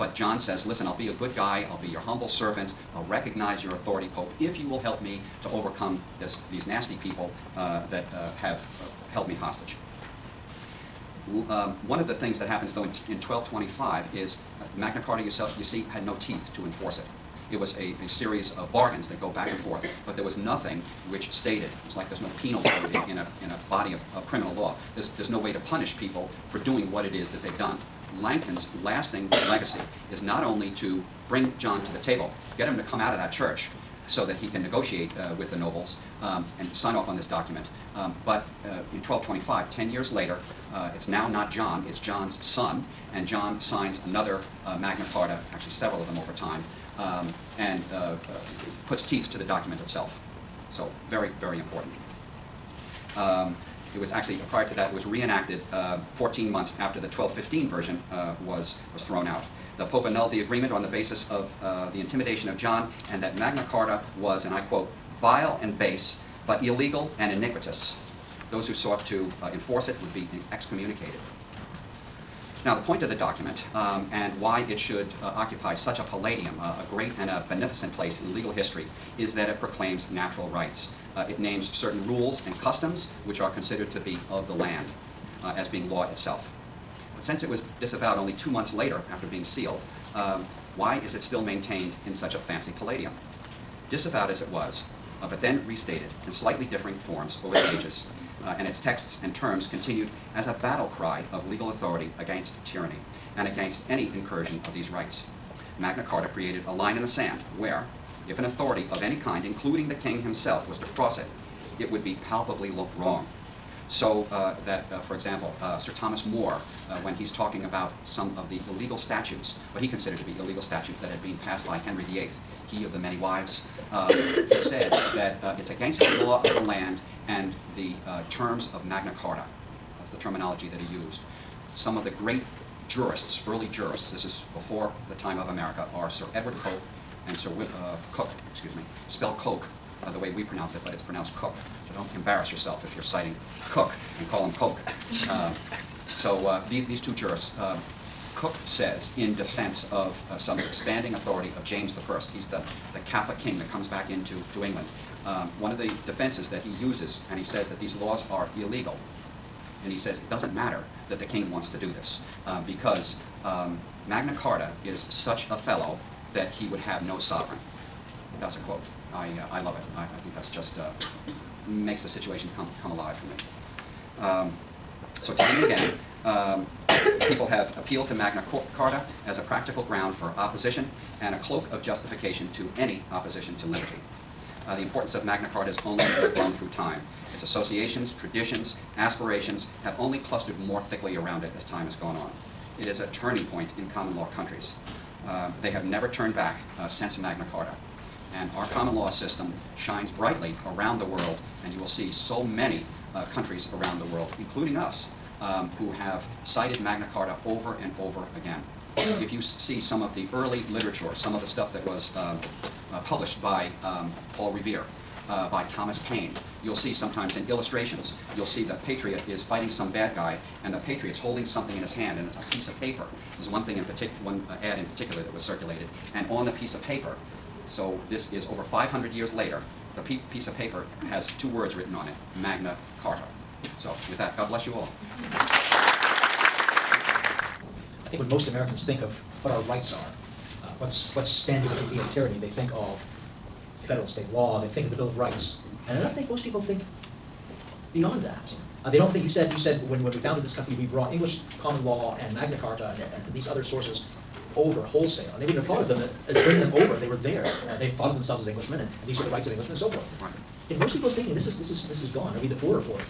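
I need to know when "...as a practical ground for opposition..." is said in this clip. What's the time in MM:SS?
02:59.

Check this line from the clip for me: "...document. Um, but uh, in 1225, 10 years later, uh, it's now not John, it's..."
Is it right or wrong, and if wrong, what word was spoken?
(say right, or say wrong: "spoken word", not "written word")
right.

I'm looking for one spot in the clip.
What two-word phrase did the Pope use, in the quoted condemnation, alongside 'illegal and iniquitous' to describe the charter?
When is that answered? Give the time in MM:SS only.
01:05.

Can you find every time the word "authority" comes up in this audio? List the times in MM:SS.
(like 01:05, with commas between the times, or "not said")
00:03, 01:41, 01:48, 02:31.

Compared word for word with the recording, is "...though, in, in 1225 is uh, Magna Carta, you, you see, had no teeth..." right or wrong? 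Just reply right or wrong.
right.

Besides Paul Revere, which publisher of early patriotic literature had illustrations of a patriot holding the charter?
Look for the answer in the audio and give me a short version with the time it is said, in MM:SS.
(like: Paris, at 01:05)
Thomas Paine, at 03:35.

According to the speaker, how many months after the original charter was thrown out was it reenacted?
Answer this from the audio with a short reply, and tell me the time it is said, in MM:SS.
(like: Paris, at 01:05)
14 months, at 00:56.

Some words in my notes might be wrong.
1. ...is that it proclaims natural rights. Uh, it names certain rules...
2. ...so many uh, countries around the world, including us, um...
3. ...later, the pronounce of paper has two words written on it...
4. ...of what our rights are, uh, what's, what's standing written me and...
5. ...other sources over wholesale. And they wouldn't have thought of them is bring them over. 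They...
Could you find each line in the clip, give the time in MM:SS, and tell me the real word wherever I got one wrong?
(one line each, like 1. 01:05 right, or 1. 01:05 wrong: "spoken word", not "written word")
1. 01:19 right
2. 03:22 right
3. 03:49 wrong: "piece", not "pronounce"
4. 03:59 wrong: "between", not "written"
5. 04:13 right.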